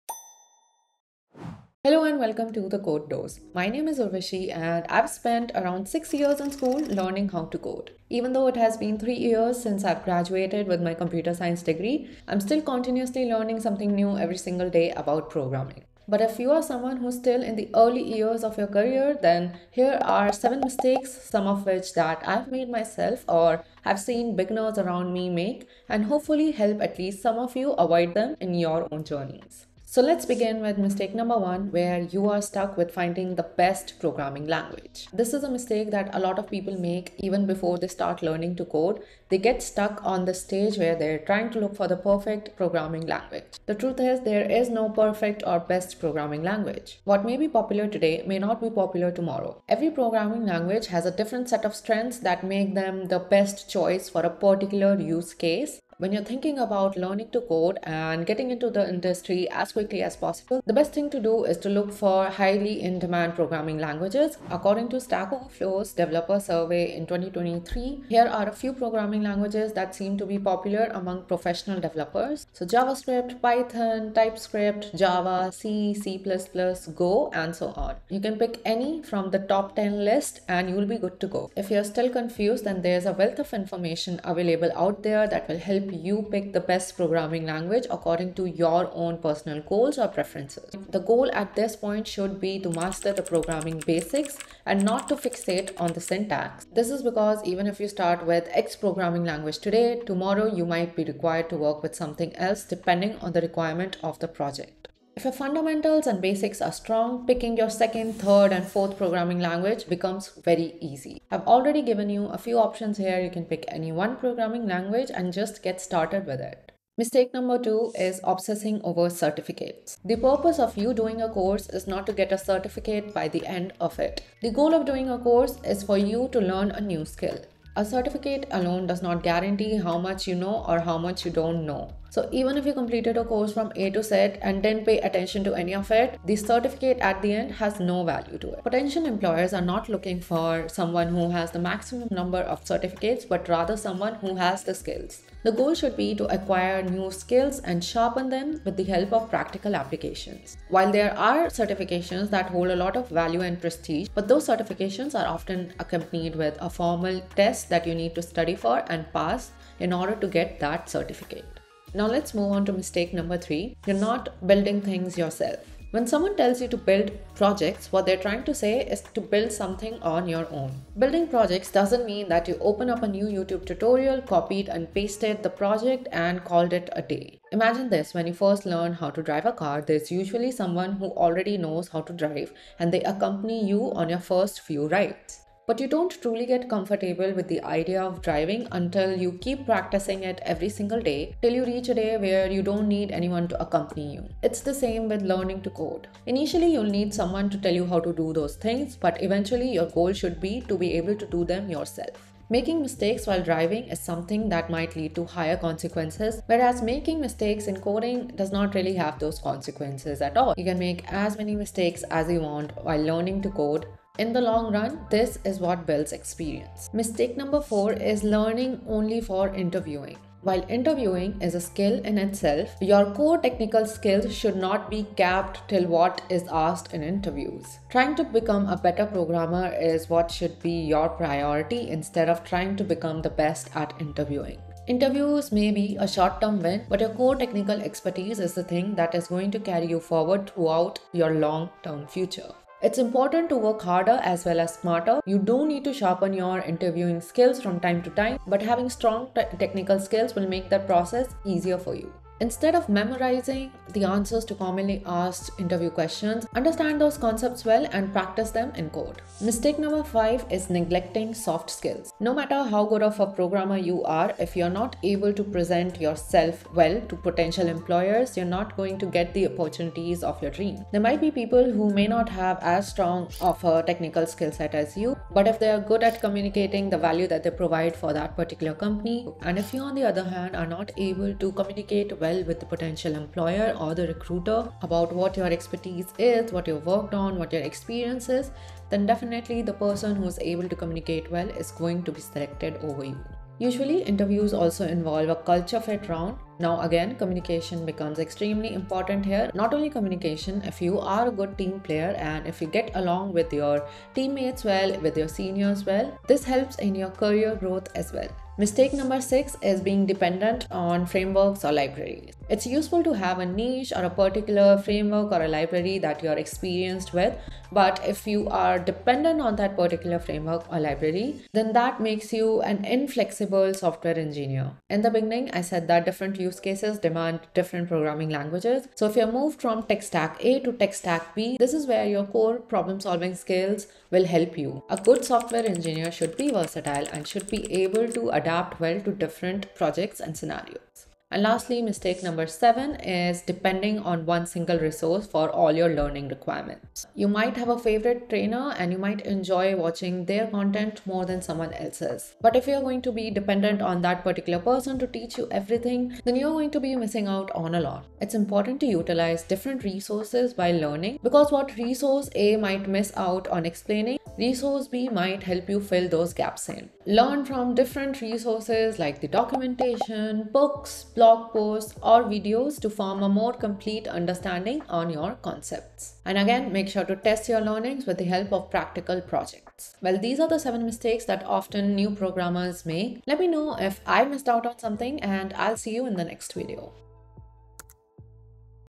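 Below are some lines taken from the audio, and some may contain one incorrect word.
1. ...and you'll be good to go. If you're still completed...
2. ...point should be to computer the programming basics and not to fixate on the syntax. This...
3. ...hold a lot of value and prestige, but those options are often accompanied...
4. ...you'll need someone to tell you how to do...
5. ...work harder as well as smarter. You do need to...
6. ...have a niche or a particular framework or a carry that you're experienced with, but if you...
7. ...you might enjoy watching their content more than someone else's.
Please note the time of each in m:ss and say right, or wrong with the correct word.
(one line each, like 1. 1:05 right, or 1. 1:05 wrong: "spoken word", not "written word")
1. 1:20 wrong: "confused", not "completed"
2. 1:31 wrong: "master", not "computer"
3. 2:32 wrong: "certifications", not "options"
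4. 3:16 right
5. 4:03 right
6. 5:13 wrong: "library", not "carry"
7. 5:48 right.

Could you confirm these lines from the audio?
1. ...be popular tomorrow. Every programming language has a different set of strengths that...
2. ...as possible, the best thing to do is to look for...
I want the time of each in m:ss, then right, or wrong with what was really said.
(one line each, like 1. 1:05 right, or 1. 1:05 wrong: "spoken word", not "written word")
1. 0:48 right
2. 1:00 right.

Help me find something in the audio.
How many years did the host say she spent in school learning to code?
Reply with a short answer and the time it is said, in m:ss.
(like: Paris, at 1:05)
6 years, at 0:05.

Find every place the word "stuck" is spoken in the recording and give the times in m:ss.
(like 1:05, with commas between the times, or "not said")
0:32, 0:39.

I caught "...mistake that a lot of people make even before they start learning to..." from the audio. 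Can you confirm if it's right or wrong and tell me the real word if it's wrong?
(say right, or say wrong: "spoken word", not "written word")
right.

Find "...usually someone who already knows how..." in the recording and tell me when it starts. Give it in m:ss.
3:00.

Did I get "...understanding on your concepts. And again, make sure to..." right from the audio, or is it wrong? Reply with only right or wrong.
right.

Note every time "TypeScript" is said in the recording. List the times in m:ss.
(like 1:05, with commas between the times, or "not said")
1:14.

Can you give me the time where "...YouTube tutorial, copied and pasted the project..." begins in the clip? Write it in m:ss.
2:53.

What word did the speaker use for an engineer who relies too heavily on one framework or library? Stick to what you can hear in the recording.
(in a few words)
Inflexible.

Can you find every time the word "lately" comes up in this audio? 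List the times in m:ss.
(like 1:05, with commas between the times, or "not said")
not said.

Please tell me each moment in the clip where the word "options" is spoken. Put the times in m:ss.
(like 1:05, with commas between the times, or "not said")
1:52.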